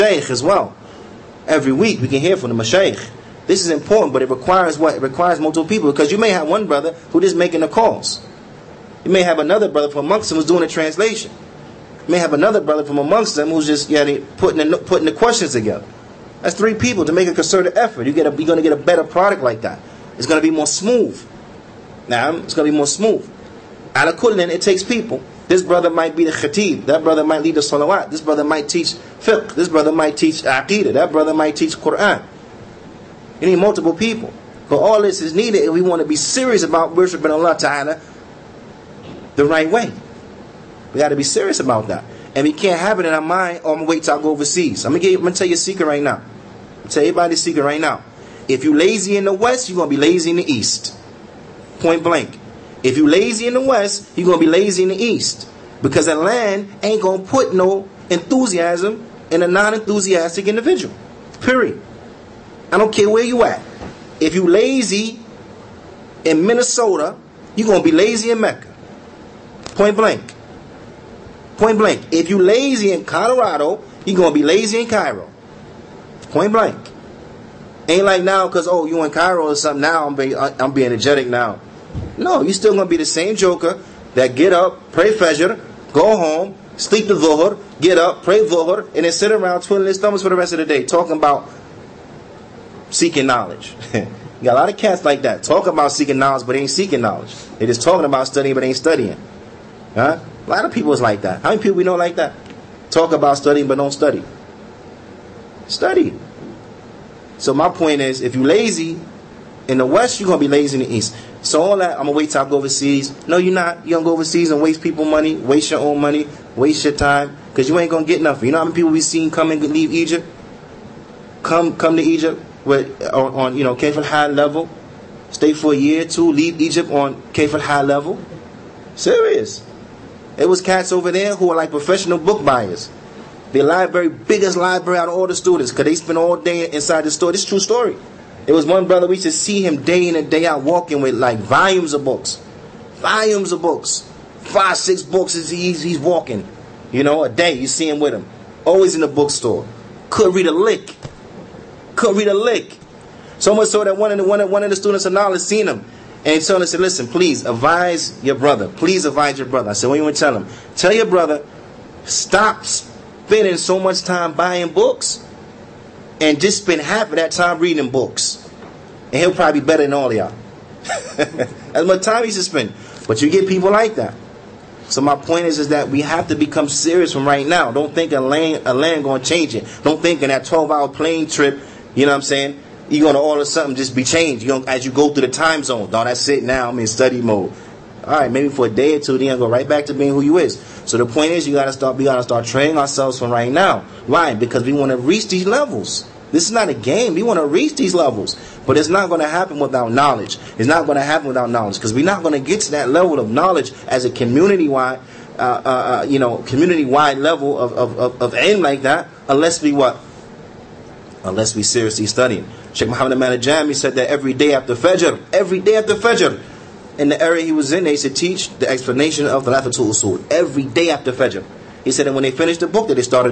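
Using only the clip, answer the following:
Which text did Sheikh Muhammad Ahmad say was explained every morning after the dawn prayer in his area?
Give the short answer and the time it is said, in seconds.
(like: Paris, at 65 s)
Thalathatul Usul, at 219 s.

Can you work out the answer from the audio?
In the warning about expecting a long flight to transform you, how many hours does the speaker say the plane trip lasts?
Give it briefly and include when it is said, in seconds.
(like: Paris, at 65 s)
12, at 180 s.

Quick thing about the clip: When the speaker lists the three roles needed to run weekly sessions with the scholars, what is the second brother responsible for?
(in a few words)
Translation.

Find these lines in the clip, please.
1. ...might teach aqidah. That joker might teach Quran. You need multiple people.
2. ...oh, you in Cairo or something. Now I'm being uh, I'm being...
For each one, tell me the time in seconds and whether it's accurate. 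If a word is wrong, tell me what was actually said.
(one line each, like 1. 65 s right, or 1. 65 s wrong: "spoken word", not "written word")
1. 29 s wrong: "brother", not "joker"
2. 78 s right.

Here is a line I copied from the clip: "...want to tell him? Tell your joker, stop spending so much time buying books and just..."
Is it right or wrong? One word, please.
wrong.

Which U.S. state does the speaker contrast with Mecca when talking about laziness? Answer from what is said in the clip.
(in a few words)
Minnesota.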